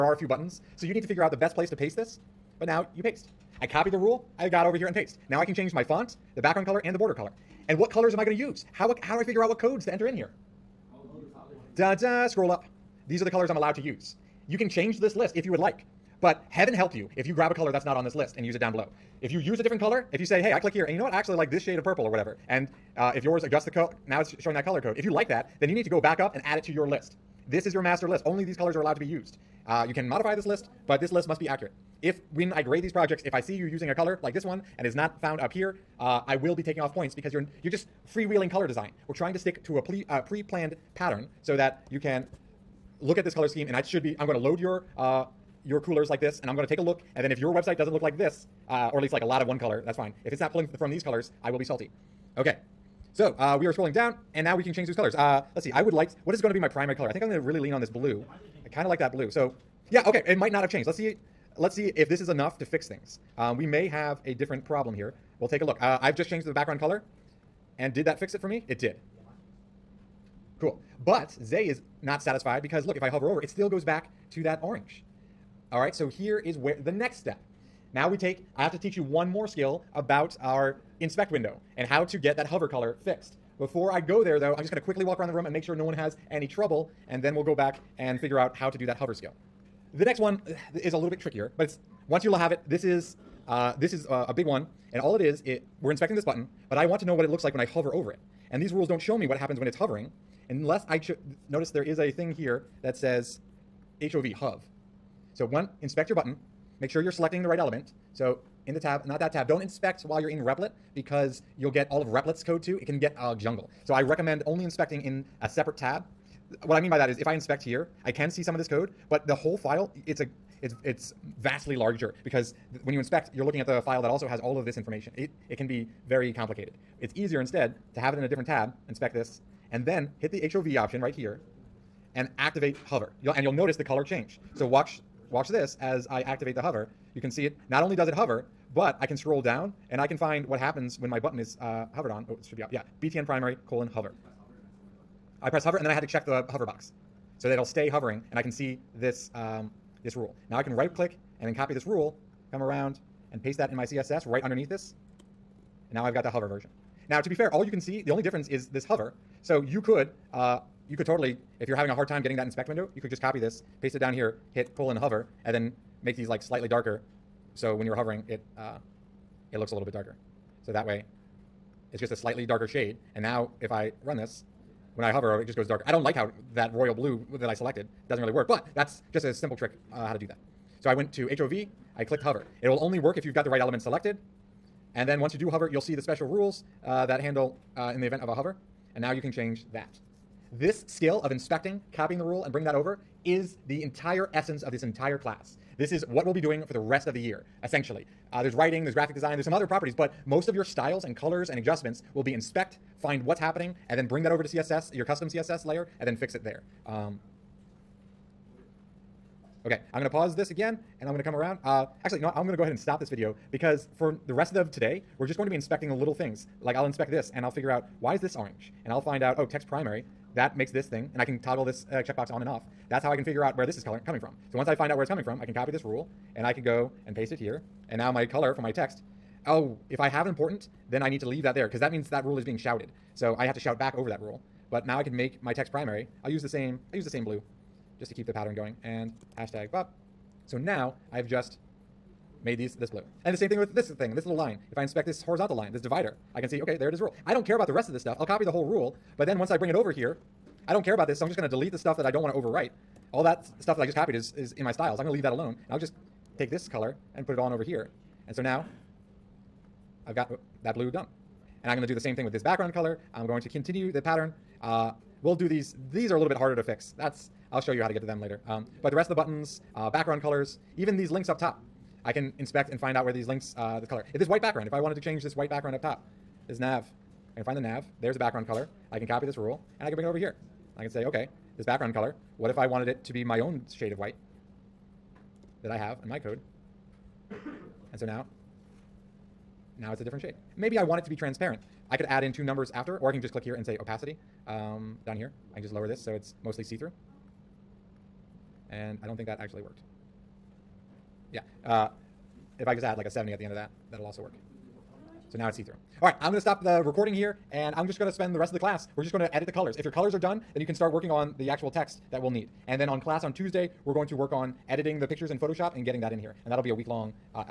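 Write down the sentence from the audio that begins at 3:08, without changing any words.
And now you can change that.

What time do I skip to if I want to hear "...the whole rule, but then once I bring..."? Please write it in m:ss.
4:08.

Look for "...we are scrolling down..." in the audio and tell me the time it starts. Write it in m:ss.
0:53.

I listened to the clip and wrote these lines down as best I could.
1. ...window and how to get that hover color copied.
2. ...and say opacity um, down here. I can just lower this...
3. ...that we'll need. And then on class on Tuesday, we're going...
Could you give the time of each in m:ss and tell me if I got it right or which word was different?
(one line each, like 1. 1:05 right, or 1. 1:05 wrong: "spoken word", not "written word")
1. 1:21 wrong: "fixed", not "copied"
2. 4:53 right
3. 5:12 right.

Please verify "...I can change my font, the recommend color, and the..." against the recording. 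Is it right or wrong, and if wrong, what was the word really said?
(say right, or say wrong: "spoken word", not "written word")
wrong: "background", not "recommend".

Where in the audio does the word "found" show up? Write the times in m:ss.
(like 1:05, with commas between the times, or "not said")
0:35.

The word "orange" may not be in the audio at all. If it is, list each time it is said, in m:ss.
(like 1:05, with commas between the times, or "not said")
1:14, 3:38.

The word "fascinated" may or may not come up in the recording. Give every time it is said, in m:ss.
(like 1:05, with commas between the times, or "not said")
not said.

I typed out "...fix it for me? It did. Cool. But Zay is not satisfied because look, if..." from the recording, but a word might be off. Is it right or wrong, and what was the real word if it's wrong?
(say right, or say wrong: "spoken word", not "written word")
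right.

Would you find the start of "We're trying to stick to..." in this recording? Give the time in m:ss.
0:39.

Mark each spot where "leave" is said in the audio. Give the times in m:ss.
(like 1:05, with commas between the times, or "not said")
3:51, 4:15.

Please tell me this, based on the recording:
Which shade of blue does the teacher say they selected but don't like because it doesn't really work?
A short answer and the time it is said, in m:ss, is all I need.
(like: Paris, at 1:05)
royal blue, at 2:56.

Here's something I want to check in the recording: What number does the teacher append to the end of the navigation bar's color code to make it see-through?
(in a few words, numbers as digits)
70.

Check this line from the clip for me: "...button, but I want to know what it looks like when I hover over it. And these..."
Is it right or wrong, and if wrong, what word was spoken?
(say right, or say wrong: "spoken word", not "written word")
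right.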